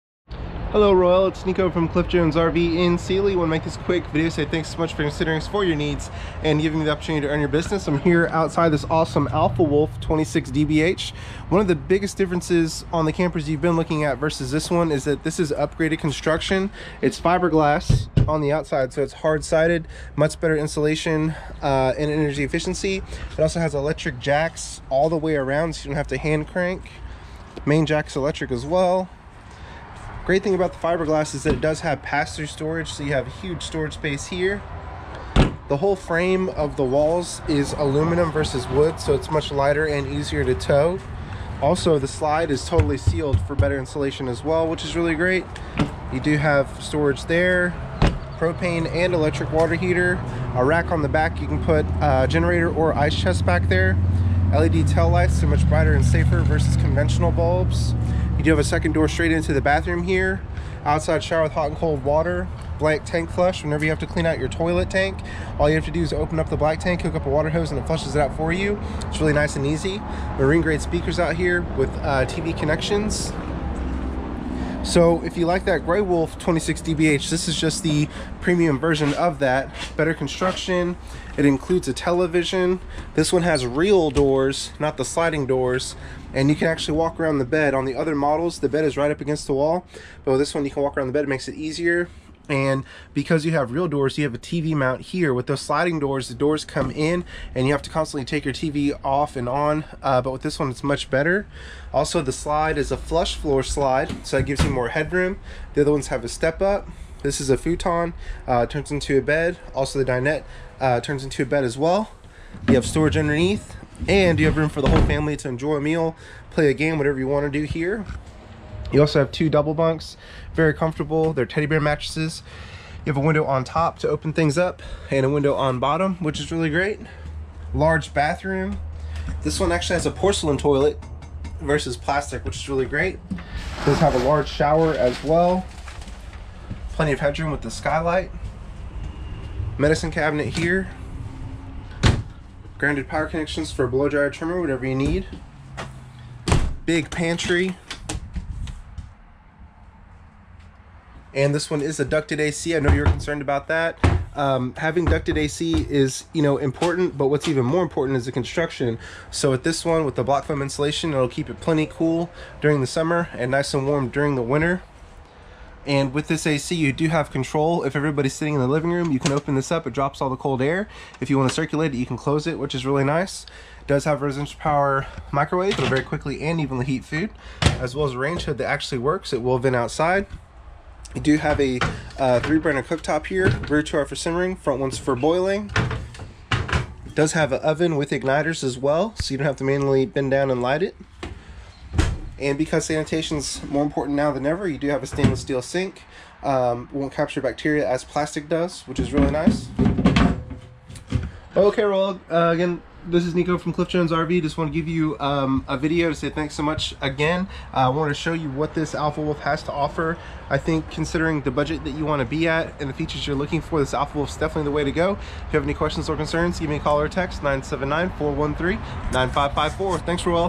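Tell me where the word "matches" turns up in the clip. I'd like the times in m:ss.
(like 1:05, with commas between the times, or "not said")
not said.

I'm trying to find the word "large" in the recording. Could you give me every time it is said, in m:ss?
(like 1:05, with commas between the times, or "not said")
2:07, 2:14.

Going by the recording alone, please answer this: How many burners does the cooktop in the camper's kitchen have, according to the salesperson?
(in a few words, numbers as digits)
3.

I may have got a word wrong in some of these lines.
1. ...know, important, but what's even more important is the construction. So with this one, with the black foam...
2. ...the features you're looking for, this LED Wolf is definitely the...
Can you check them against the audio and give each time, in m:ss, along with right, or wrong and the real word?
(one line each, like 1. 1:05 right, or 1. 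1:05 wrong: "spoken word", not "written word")
1. 2:36 wrong: "block", not "black"
2. 3:32 wrong: "Alpha", not "LED".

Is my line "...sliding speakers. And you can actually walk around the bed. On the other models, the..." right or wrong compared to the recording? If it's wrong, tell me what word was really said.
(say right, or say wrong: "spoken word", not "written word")
wrong: "doors", not "speakers".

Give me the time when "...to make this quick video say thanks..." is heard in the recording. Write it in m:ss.
0:03.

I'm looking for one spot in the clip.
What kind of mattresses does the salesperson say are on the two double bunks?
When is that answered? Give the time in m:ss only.
2:01.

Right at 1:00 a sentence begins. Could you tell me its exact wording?
Outside shower with hot and cold water.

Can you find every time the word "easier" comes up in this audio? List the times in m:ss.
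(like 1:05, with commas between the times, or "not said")
0:40, 1:31.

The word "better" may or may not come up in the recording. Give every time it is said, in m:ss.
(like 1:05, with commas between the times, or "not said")
0:20, 0:43, 1:19, 1:41.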